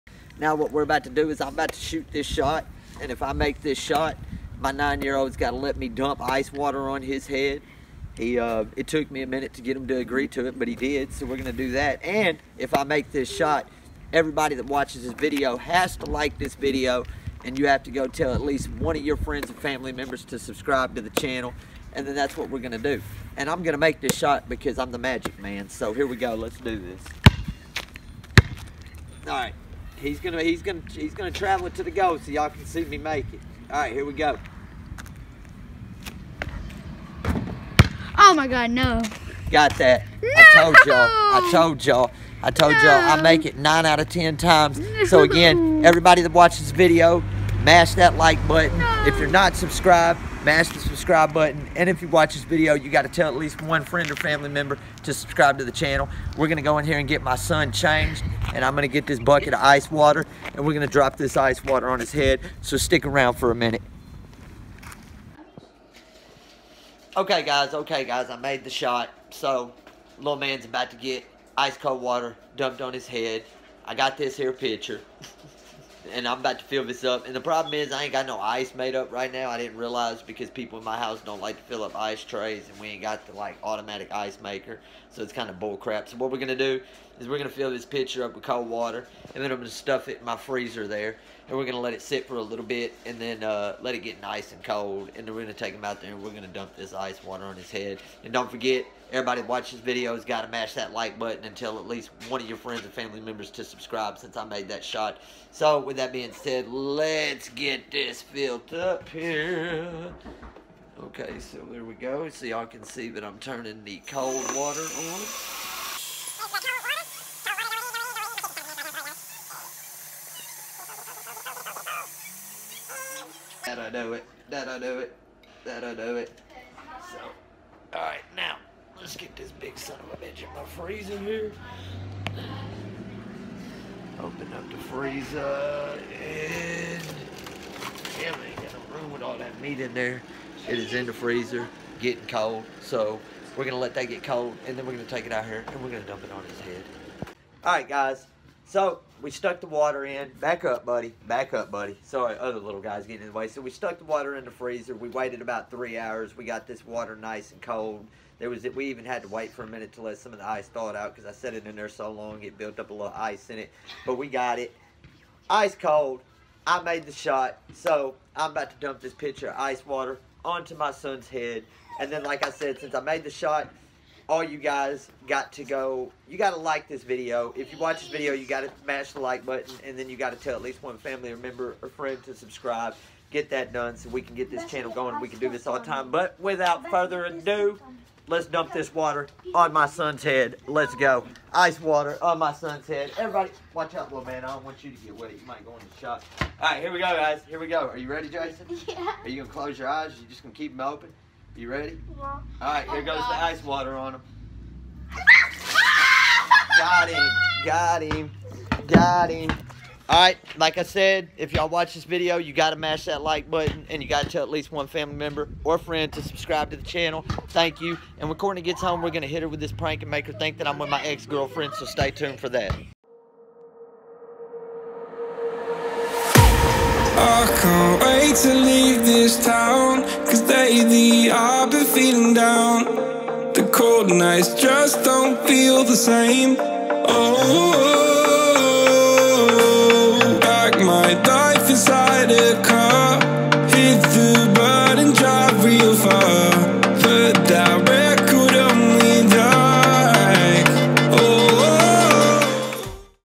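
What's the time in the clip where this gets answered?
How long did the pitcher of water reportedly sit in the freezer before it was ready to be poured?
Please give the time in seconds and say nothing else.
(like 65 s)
155 s.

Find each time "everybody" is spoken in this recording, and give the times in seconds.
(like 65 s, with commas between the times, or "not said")
14 s, 45 s, 99 s, 193 s.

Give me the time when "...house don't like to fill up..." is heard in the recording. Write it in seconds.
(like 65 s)
80 s.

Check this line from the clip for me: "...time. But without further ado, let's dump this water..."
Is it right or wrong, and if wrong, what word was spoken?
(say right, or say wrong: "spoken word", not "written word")
right.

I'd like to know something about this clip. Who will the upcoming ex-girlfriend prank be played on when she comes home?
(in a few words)
Courtney.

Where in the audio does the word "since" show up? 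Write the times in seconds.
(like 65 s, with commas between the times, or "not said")
104 s, 172 s.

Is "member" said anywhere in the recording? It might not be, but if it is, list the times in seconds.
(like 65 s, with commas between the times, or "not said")
19 s, 54 s, 103 s, 181 s, 215 s.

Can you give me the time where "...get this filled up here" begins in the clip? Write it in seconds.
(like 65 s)
107 s.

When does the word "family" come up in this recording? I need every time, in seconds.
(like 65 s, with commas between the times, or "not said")
19 s, 54 s, 102 s, 180 s, 214 s.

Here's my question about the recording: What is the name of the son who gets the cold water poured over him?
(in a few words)
Jason.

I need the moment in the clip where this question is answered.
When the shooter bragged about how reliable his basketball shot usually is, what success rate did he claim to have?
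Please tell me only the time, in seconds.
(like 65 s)
43 s.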